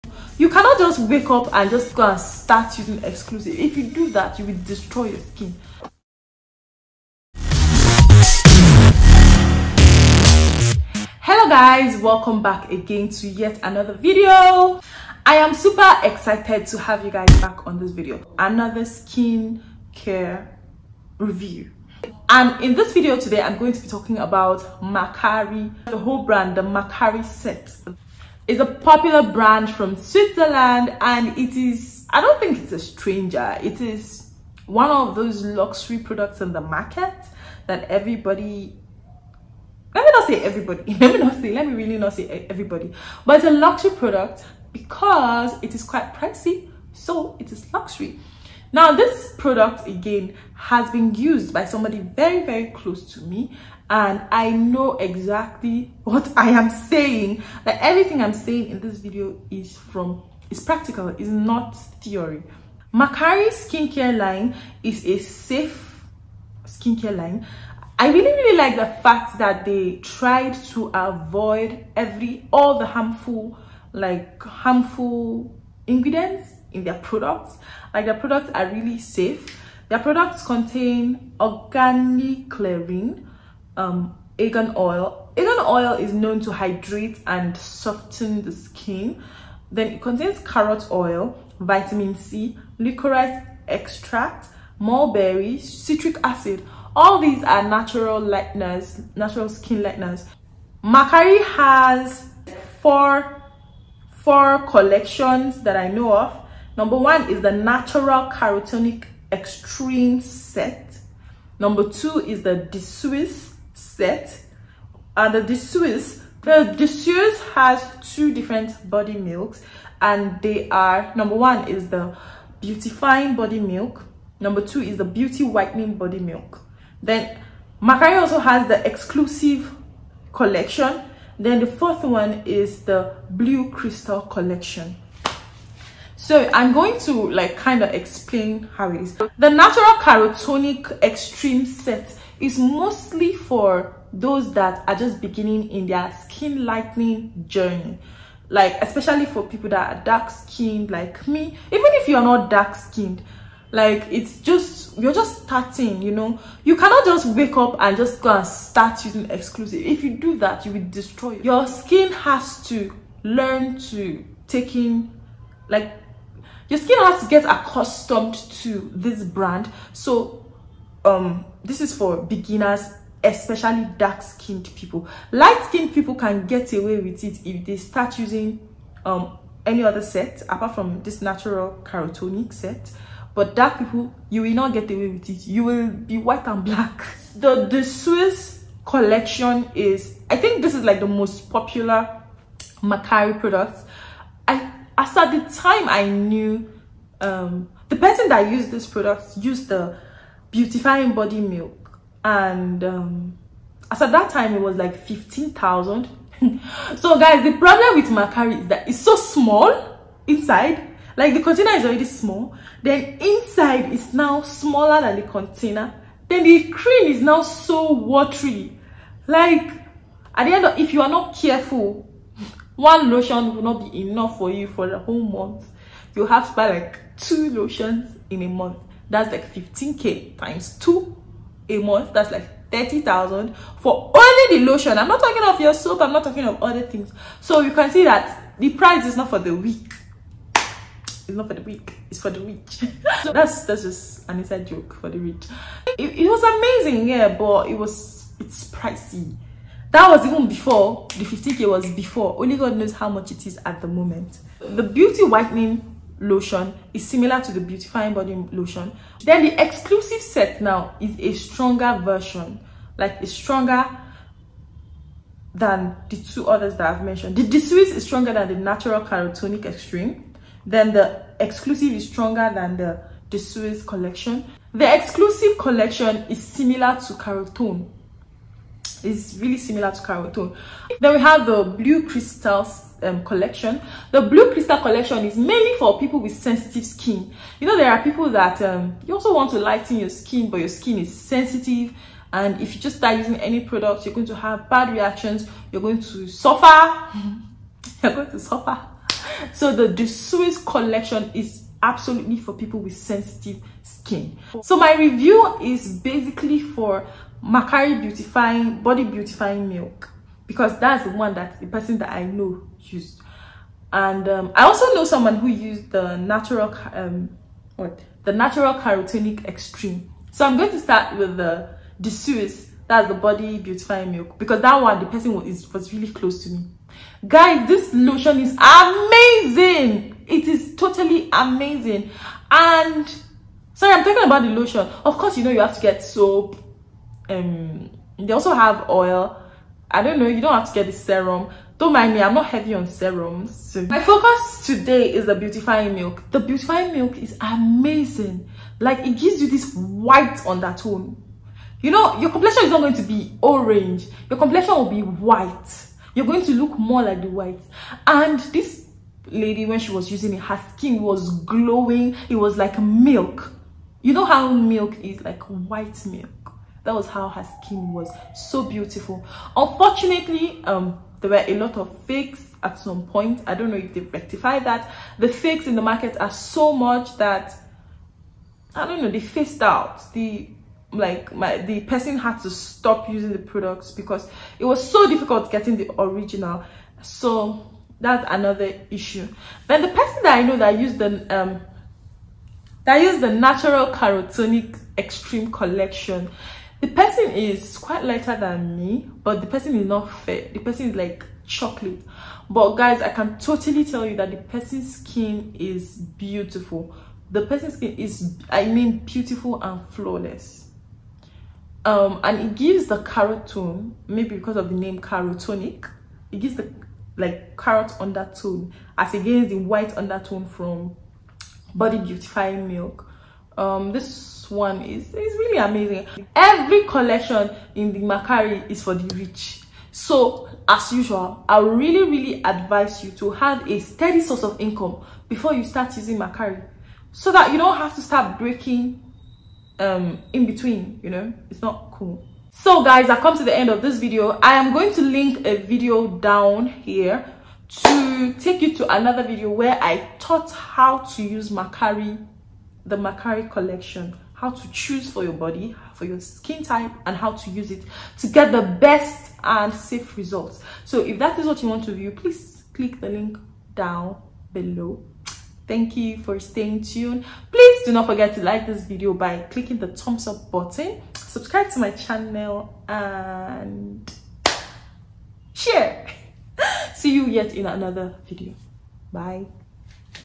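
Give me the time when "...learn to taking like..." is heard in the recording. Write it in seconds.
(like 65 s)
163 s.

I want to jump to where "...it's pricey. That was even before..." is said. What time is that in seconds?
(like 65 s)
248 s.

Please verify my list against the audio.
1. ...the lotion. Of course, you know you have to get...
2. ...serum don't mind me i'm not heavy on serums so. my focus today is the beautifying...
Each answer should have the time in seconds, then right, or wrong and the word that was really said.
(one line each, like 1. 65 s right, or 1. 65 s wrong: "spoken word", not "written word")
1. 334 s right
2. 340 s right.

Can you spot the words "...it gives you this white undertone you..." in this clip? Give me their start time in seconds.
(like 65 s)
348 s.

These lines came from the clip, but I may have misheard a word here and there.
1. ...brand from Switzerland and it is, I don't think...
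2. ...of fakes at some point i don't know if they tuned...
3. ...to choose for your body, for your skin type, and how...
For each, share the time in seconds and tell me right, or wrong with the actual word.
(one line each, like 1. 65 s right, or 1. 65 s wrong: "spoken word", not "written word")
1. 29 s right
2. 371 s wrong: "rectified", not "tuned"
3. 454 s right.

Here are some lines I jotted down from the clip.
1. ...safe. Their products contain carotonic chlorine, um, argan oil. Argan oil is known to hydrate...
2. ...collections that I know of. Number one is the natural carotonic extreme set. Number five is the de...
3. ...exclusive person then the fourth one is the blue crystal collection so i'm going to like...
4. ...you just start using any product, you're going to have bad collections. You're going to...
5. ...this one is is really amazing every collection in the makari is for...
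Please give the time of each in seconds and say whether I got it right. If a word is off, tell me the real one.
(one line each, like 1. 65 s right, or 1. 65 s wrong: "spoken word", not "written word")
1. 78 s wrong: "organic", not "carotonic"
2. 104 s wrong: "two", not "five"
3. 128 s wrong: "collection", not "person"
4. 292 s wrong: "reactions", not "collections"
5. 423 s right.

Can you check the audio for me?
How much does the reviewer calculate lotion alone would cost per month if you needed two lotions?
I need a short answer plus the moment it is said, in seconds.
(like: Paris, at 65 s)
30,000, at 232 s.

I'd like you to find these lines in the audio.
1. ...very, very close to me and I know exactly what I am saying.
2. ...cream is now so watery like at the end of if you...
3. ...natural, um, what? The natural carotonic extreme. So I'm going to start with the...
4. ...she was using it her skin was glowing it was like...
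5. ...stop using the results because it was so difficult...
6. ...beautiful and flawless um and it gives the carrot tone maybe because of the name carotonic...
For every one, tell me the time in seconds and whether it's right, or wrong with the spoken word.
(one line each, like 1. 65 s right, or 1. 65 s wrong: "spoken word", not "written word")
1. 51 s right
2. 216 s right
3. 316 s right
4. 359 s right
5. 382 s wrong: "products", not "results"
6. 409 s right.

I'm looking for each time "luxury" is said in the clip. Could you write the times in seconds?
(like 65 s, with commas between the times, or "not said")
35 s, 43 s, 47 s.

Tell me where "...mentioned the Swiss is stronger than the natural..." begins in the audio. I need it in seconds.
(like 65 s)
267 s.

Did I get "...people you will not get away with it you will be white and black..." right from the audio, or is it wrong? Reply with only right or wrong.
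right.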